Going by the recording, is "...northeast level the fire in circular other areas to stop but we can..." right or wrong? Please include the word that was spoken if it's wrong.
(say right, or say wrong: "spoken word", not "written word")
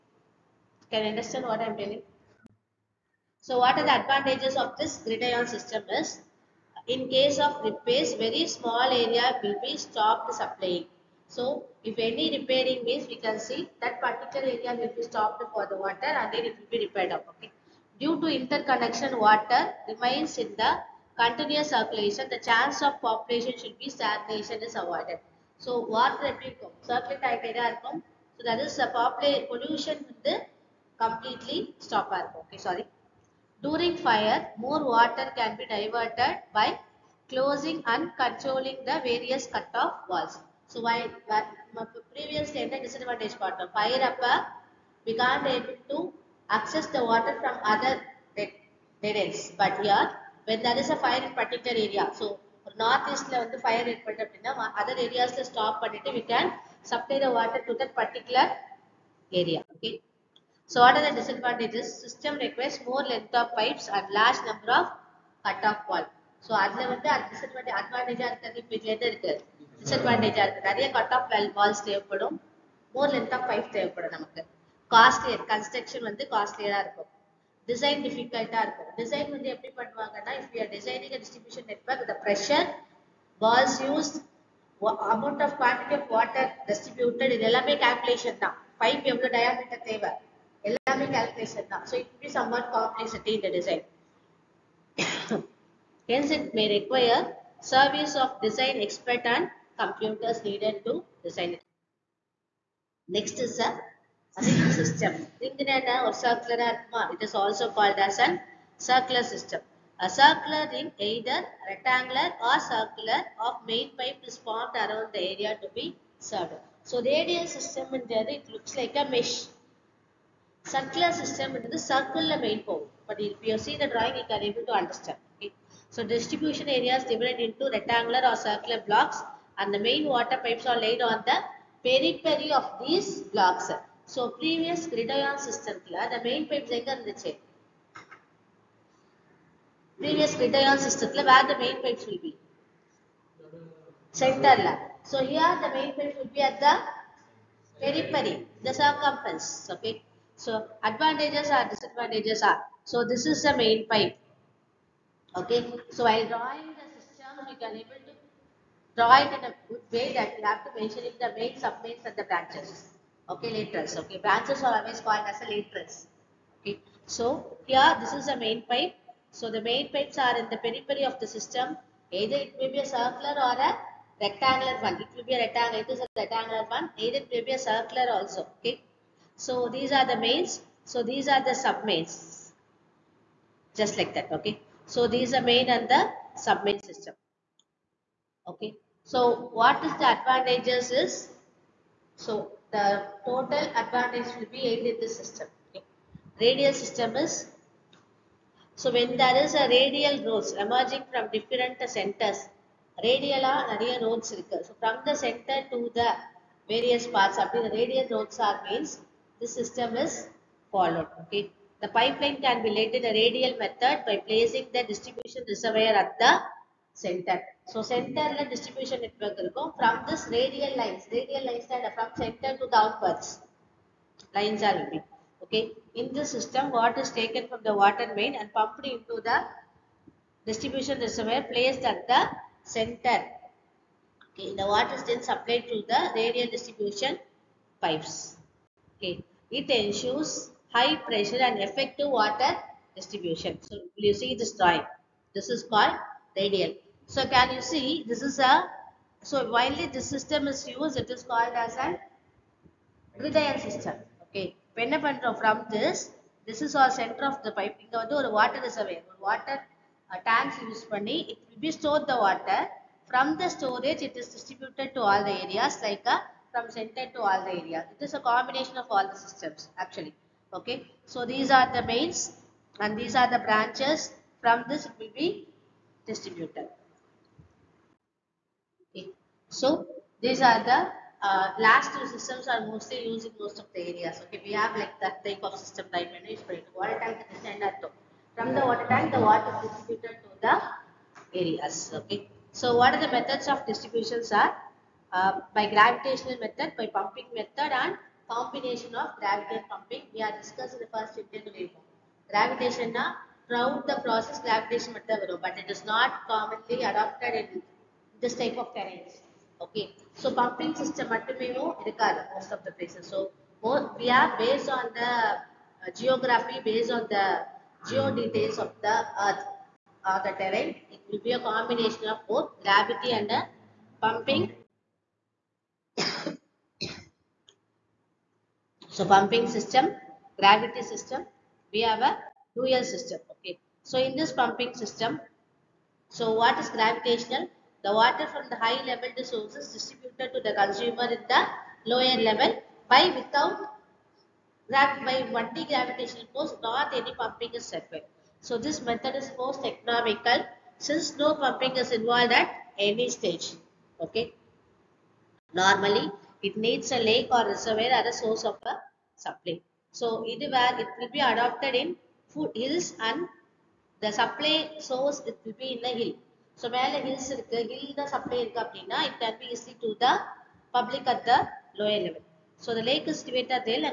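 wrong: "particular", not "circular".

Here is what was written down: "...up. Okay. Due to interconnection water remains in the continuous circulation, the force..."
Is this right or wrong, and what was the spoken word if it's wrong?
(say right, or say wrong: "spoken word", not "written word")
wrong: "chance", not "force".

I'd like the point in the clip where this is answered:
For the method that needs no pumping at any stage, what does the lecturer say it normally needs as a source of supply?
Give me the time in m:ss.
5:57.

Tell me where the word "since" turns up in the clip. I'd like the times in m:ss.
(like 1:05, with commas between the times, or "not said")
5:50.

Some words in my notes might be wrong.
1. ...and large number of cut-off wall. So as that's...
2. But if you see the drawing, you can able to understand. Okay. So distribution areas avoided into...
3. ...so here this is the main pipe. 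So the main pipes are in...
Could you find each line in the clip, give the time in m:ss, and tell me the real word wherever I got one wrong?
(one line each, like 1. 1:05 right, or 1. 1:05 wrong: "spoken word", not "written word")
1. 1:03 right
2. 2:03 wrong: "divided", not "avoided"
3. 2:47 right.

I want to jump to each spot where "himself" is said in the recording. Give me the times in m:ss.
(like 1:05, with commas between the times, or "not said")
not said.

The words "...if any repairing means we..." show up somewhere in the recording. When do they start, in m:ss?
0:11.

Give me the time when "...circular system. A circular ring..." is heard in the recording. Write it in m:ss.
1:48.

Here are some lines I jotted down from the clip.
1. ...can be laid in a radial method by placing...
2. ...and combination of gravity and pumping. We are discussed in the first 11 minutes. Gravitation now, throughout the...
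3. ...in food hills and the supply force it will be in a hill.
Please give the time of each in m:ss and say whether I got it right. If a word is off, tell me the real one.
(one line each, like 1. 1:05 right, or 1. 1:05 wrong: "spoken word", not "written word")
1. 3:32 right
2. 4:57 wrong: "15", not "11"
3. 6:01 wrong: "source", not "force".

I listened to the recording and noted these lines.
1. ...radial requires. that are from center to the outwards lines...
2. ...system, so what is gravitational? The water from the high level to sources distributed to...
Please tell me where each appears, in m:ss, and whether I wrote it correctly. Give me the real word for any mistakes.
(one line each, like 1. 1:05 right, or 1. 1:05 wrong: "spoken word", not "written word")
1. 3:41 wrong: "lines", not "requires"
2. 5:34 right.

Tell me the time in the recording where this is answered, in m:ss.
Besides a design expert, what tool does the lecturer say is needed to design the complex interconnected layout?
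1:39.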